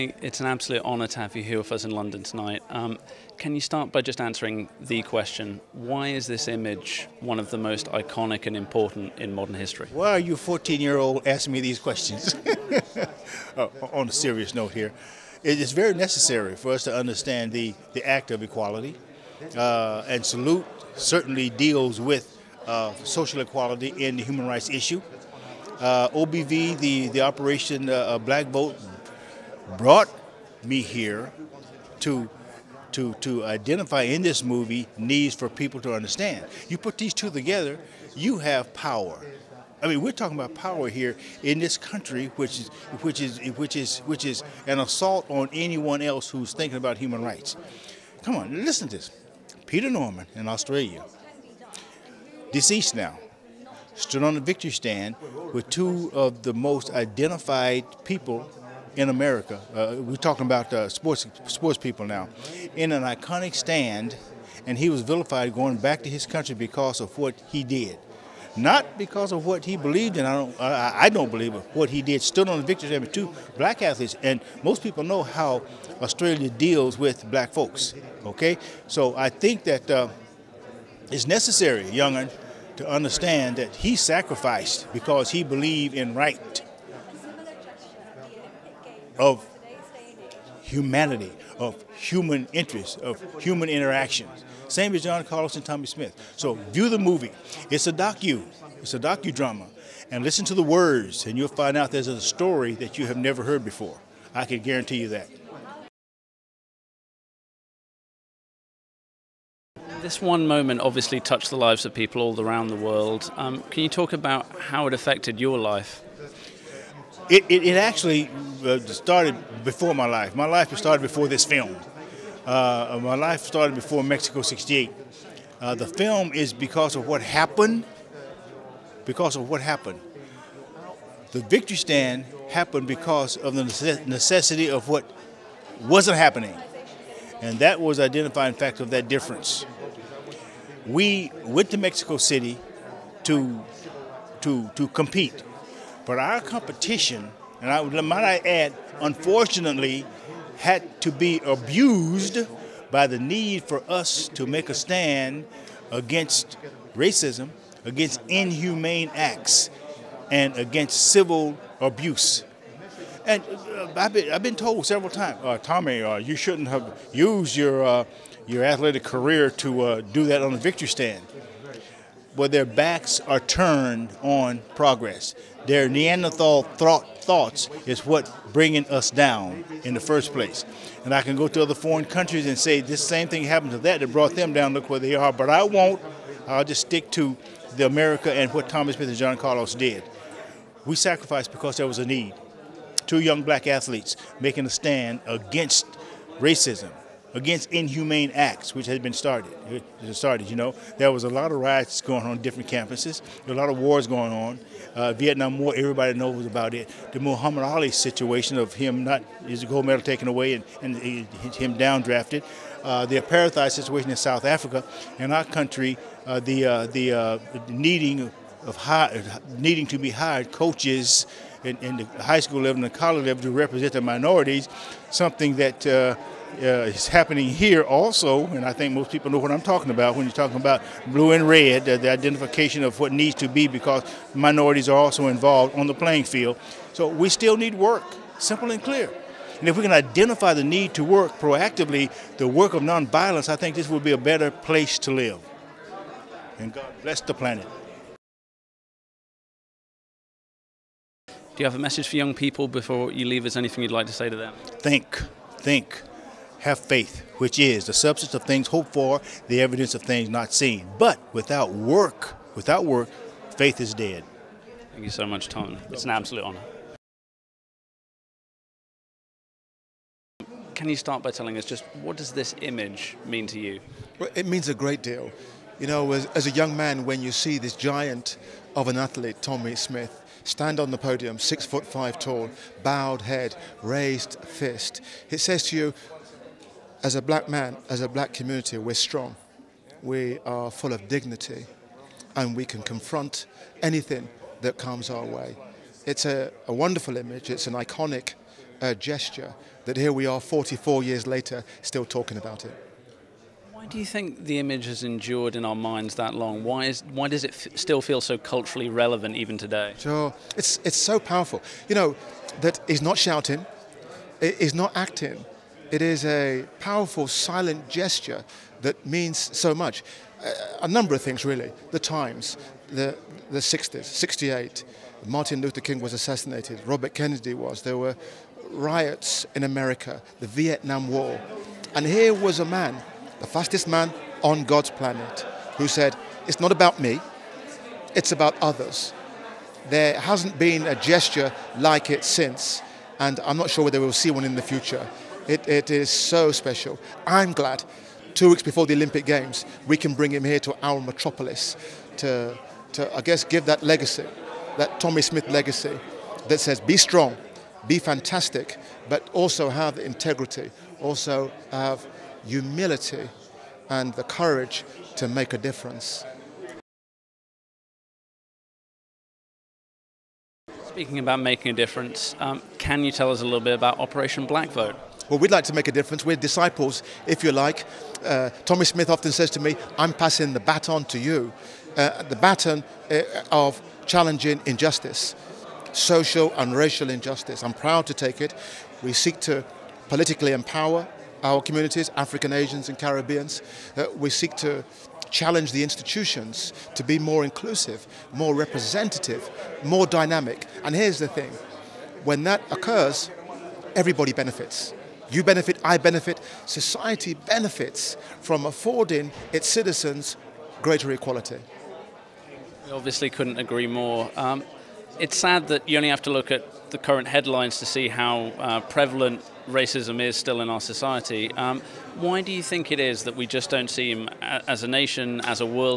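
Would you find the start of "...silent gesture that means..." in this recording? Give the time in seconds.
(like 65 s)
317 s.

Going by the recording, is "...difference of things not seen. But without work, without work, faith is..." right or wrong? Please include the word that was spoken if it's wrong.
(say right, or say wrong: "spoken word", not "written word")
wrong: "evidence", not "difference".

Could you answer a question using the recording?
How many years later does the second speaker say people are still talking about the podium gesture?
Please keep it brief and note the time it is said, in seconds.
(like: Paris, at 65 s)
44, at 300 s.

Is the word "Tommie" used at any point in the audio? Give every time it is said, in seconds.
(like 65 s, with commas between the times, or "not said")
95 s, 165 s, 279 s, 355 s, 378 s.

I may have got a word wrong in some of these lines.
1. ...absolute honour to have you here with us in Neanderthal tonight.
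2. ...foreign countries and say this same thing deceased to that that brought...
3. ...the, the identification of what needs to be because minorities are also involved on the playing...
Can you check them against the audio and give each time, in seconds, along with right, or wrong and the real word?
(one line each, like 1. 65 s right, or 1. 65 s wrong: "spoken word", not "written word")
1. 0 s wrong: "London", not "Neanderthal"
2. 181 s wrong: "happened", not "deceased"
3. 231 s right.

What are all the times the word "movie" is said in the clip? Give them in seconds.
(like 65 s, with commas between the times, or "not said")
34 s, 96 s.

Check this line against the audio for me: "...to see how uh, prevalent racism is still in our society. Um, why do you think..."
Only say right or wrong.
right.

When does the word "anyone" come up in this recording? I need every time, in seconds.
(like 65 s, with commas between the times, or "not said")
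45 s.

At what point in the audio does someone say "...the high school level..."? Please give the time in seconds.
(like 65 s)
221 s.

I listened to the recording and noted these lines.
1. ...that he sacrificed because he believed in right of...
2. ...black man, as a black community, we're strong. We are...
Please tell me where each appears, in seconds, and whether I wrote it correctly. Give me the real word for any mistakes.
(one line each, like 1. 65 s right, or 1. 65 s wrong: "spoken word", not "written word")
1. 83 s right
2. 287 s right.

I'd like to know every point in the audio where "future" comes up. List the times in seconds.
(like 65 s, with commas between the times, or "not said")
344 s.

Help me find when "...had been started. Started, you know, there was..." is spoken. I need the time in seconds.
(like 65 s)
198 s.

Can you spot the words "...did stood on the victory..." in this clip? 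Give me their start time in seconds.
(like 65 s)
72 s.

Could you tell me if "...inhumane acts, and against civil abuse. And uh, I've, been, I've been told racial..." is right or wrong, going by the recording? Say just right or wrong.
wrong.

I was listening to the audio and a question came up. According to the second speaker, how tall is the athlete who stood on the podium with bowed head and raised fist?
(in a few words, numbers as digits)
6 foot 5.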